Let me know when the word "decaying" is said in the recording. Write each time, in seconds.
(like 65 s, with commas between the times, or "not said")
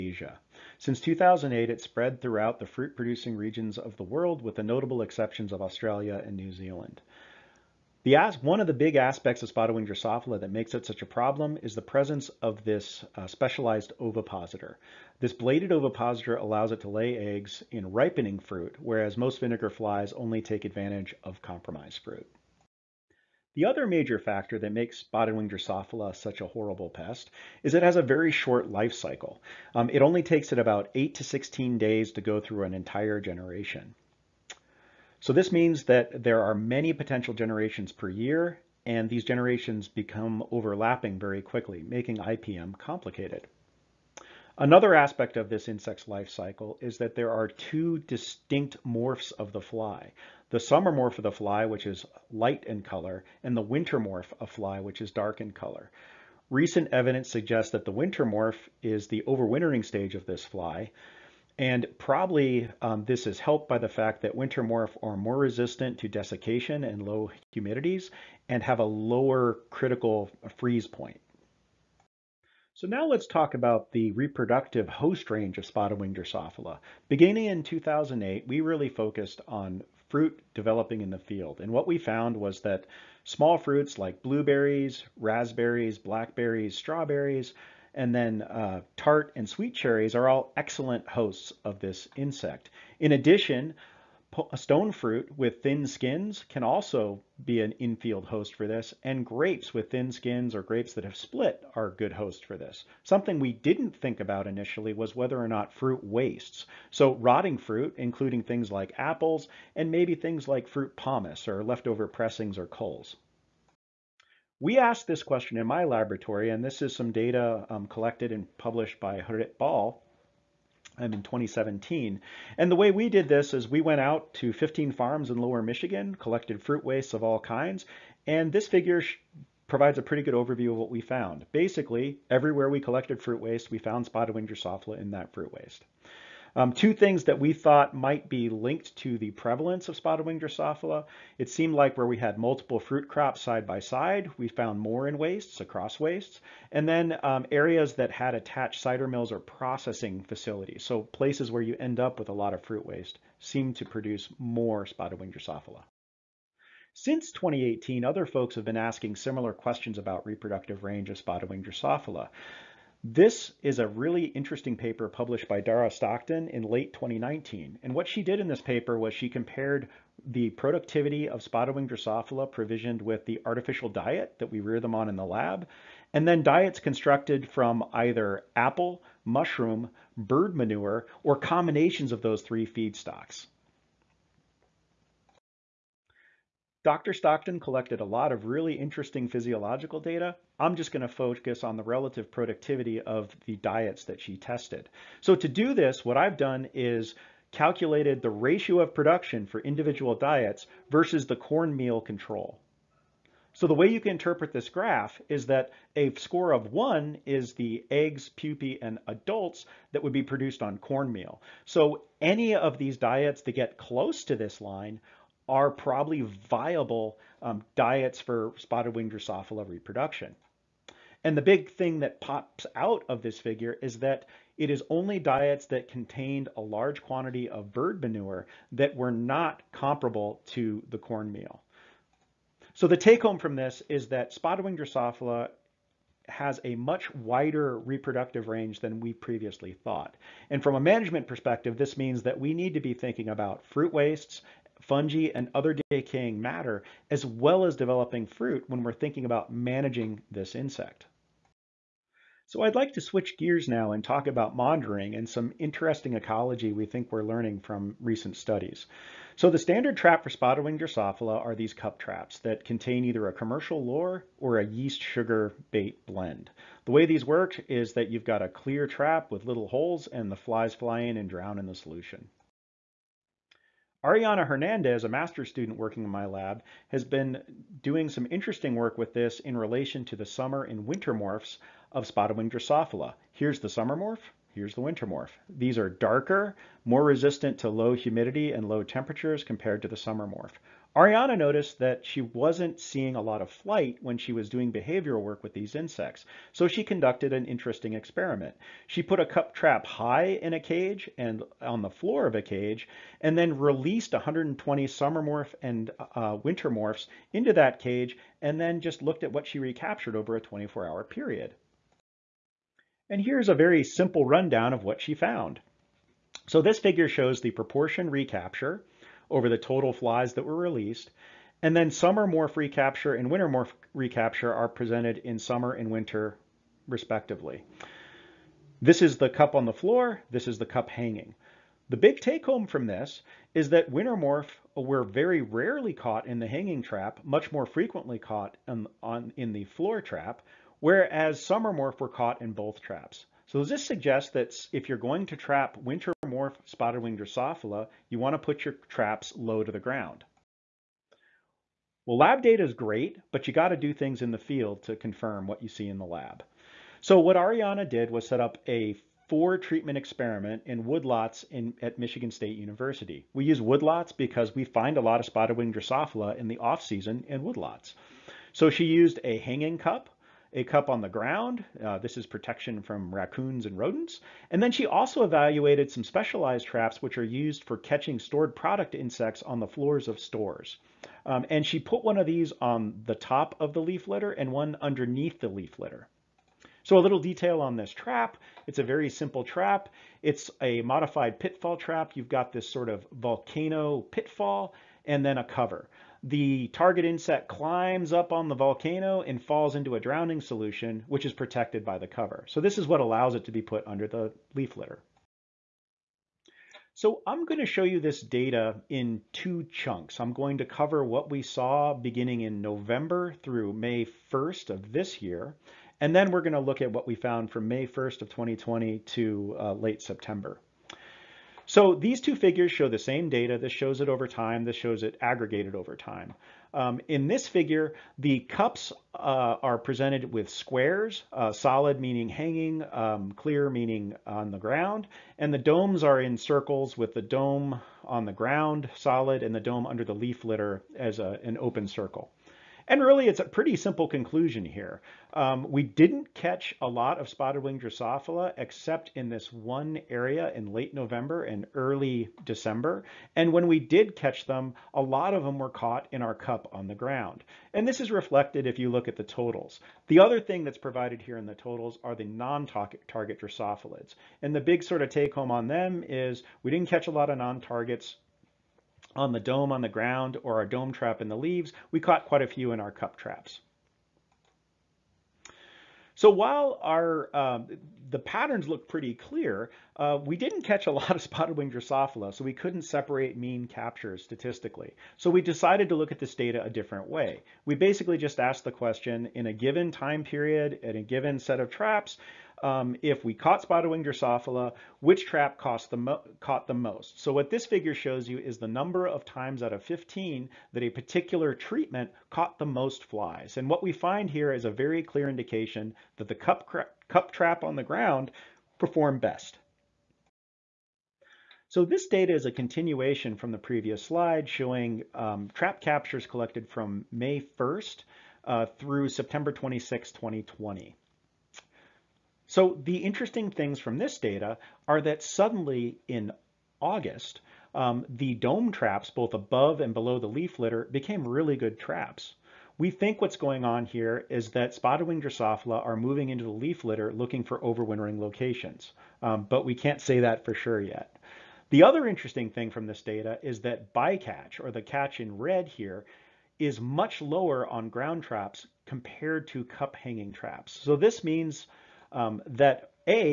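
245 s.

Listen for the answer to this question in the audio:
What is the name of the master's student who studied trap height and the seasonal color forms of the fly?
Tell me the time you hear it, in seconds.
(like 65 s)
274 s.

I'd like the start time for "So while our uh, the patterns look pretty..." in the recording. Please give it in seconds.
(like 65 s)
476 s.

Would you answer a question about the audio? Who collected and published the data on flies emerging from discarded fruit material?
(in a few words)
Harit Bal.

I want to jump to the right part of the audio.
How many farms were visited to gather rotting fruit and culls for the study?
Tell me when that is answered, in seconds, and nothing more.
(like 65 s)
124 s.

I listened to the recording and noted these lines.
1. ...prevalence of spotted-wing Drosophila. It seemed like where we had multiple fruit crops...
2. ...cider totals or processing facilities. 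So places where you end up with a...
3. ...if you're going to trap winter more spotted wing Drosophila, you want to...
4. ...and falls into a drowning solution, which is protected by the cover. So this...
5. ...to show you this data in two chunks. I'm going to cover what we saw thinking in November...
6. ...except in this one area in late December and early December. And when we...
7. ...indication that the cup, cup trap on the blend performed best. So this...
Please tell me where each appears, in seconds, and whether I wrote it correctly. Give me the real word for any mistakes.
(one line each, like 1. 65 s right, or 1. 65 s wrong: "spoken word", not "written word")
1. 139 s right
2. 148 s wrong: "mills", not "totals"
3. 344 s right
4. 399 s right
5. 407 s wrong: "beginning", not "thinking"
6. 448 s wrong: "November", not "December"
7. 505 s wrong: "ground", not "blend".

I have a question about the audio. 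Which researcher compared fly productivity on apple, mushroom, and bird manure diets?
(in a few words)
Dara Stockton.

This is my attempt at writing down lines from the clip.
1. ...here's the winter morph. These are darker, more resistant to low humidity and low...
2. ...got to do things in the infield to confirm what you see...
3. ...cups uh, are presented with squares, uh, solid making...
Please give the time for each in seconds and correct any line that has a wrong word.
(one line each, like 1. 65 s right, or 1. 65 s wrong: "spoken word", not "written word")
1. 284 s right
2. 353 s wrong: "field", not "infield"
3. 428 s wrong: "meaning", not "making".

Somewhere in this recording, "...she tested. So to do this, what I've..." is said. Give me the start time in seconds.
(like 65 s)
194 s.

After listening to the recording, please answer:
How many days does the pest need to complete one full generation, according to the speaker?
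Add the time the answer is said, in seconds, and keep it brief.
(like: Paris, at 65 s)
8 to 16 days, at 30 s.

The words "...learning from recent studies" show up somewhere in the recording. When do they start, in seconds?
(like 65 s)
257 s.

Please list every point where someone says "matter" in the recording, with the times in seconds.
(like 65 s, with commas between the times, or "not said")
246 s.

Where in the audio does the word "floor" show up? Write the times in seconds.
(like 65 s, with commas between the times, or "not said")
301 s, 329 s, 339 s, 379 s.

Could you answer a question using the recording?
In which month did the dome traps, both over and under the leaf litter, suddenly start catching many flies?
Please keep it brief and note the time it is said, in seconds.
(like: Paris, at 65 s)
August, at 526 s.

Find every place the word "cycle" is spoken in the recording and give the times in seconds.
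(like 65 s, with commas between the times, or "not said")
28 s, 46 s.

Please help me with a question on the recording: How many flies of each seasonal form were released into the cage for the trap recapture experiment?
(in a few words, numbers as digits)
120.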